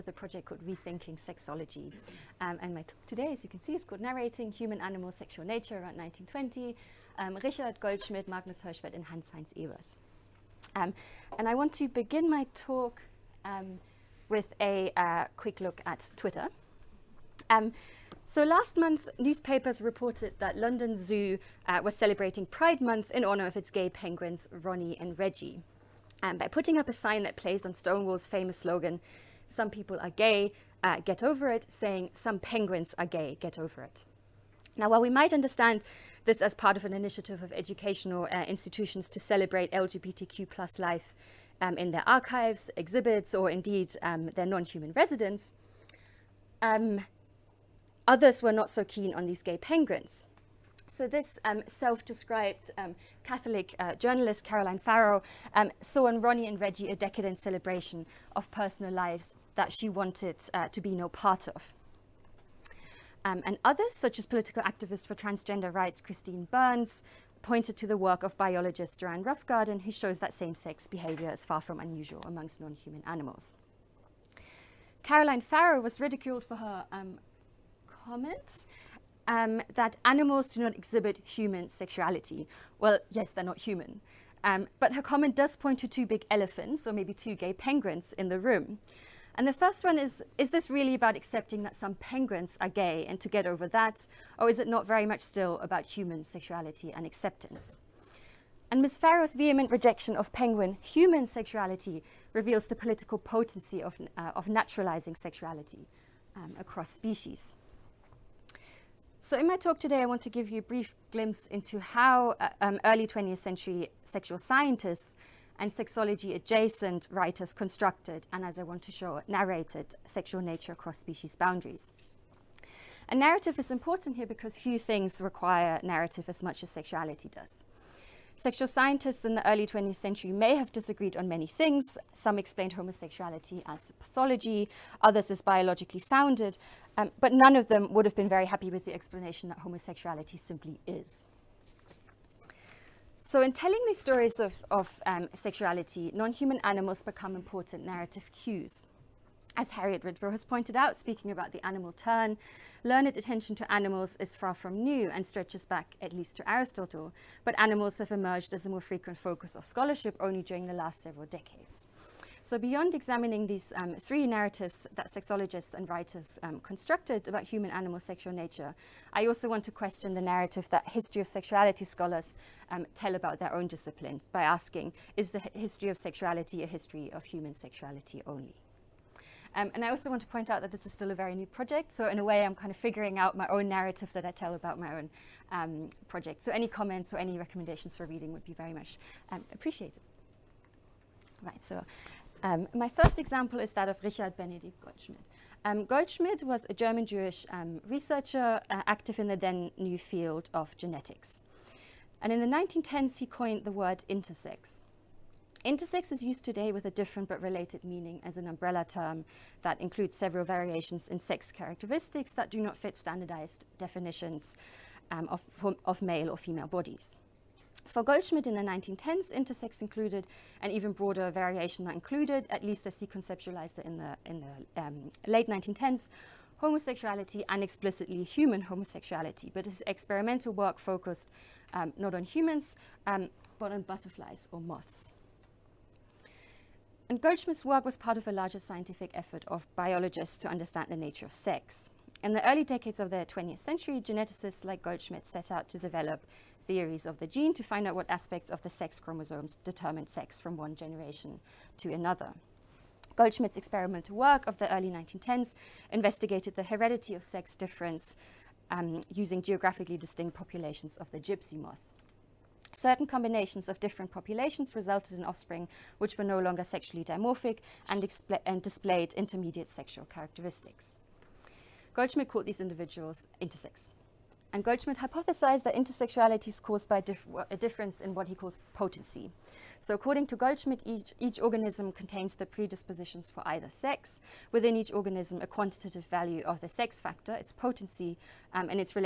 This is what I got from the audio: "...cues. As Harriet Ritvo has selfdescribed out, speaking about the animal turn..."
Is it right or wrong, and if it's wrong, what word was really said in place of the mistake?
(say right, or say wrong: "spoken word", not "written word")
wrong: "pointed", not "selfdescribed".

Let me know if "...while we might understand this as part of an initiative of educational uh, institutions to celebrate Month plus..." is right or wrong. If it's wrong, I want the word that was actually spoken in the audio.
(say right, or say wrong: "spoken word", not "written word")
wrong: "LGBTQ", not "Month".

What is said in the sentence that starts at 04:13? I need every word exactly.
Goldschmidt's experimental work of the early 1910s investigated the heredity of sex difference um, using geographically distinct populations of the gypsy moth.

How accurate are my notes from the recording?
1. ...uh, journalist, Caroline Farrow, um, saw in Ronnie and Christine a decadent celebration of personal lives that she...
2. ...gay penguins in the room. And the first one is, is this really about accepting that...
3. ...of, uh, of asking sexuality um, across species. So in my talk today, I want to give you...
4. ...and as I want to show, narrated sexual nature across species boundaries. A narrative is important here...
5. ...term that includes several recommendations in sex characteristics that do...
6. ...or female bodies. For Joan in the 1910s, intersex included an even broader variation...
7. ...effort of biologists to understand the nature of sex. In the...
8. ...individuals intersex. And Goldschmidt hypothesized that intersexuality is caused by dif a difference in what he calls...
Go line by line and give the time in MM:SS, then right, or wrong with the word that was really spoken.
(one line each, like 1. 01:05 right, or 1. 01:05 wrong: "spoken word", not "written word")
1. 00:53 wrong: "Reggie", not "Christine"
2. 01:27 right
3. 01:43 wrong: "naturalizing", not "asking"
4. 01:58 right
5. 03:28 wrong: "variations", not "recommendations"
6. 03:36 wrong: "Goldschmidt", not "Joan"
7. 03:59 right
8. 04:32 right.